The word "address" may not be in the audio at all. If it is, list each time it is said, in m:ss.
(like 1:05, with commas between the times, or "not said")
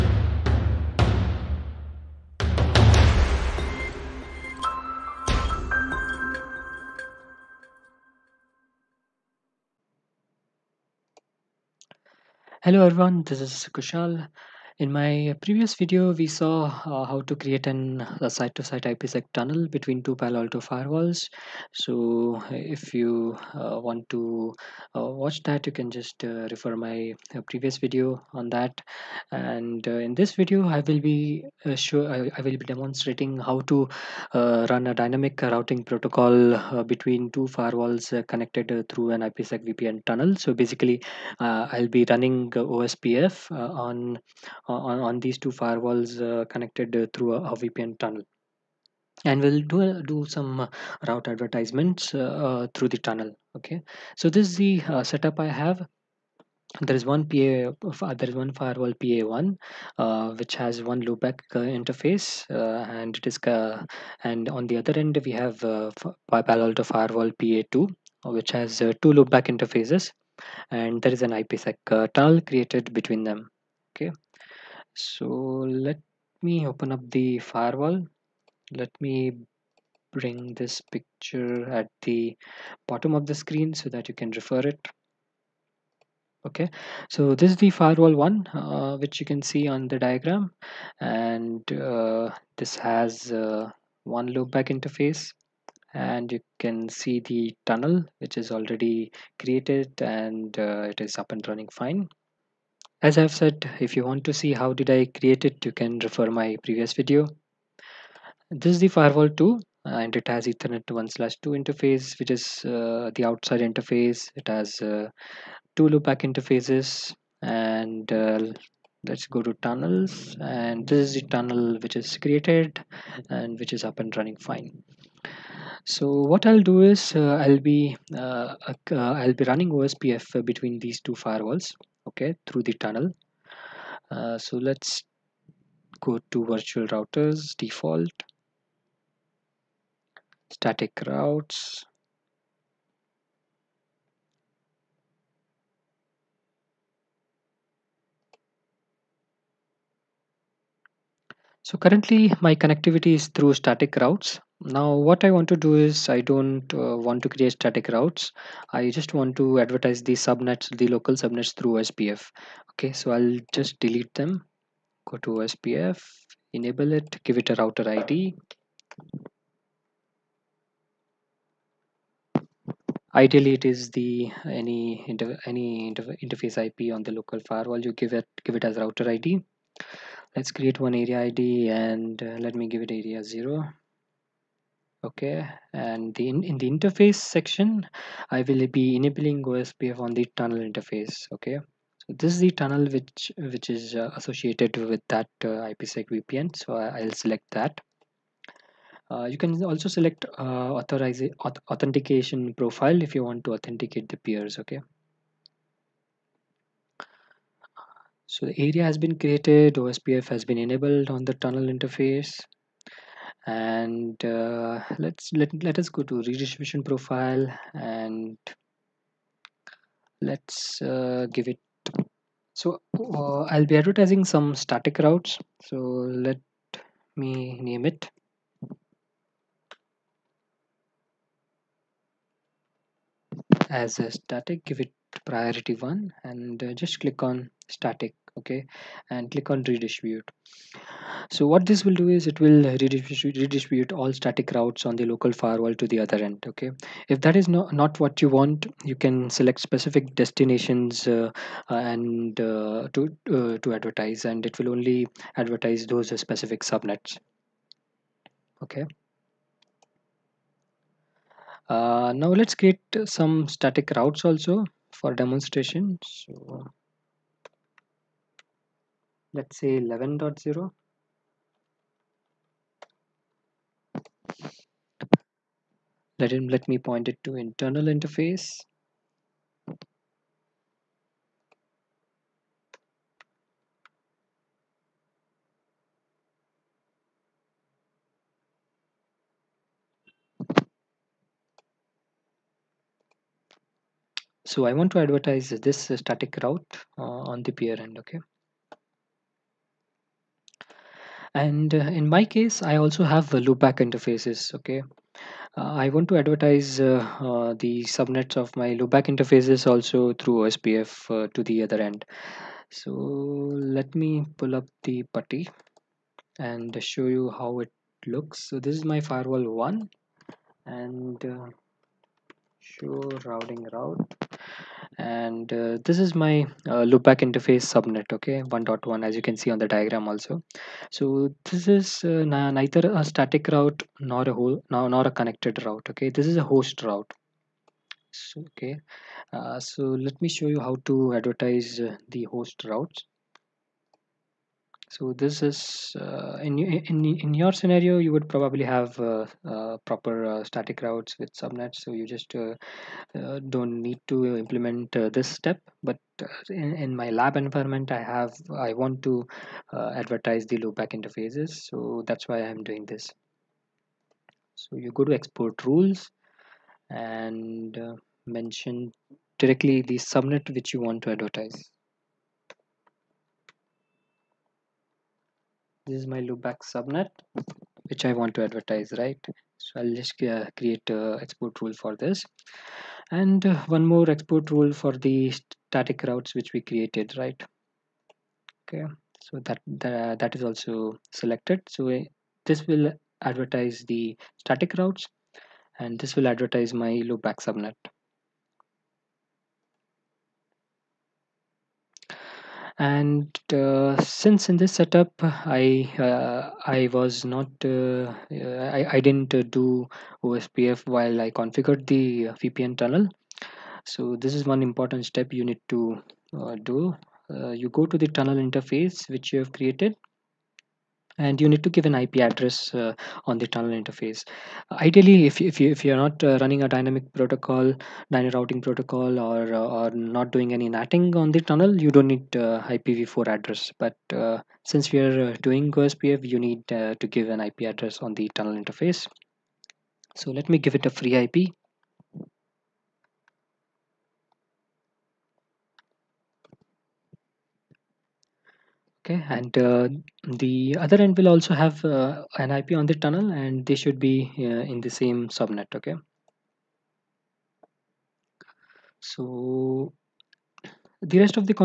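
7:02, 7:13, 7:17.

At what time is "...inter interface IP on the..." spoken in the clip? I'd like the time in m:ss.
2:55.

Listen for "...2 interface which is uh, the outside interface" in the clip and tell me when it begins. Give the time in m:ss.
1:51.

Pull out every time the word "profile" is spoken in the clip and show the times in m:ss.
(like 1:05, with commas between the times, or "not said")
3:22, 3:36.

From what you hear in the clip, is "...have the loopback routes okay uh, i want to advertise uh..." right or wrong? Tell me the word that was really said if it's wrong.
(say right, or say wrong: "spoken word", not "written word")
wrong: "interfaces", not "routes".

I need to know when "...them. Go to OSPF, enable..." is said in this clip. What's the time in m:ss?
2:44.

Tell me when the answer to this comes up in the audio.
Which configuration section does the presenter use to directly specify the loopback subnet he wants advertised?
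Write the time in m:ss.
6:05.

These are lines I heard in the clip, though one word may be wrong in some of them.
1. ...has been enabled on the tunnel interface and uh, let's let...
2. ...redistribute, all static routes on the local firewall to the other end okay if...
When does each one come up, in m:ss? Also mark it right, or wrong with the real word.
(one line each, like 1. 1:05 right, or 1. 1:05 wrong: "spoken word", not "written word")
1. 3:30 right
2. 4:02 right.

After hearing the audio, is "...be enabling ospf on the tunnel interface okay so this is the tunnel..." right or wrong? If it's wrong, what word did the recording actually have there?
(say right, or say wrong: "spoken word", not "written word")
right.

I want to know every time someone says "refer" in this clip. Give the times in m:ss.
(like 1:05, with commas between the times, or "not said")
0:26, 1:24, 1:46.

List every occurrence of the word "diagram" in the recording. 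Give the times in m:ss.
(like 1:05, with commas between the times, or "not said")
1:30, 5:29.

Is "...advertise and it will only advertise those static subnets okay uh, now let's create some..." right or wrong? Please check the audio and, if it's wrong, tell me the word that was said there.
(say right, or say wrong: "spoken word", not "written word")
wrong: "specific", not "static".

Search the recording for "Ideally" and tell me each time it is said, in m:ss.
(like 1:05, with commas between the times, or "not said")
2:53, 7:04.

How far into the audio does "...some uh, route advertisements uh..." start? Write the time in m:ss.
0:50.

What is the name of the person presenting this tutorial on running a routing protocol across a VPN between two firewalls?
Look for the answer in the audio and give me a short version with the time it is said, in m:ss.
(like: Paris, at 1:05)
Kushal, at 0:13.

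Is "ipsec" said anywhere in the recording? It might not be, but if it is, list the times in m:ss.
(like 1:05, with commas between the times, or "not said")
0:18, 0:39, 1:11, 3:15.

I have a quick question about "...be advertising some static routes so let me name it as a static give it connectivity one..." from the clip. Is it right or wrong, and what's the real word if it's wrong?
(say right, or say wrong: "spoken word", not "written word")
wrong: "priority", not "connectivity".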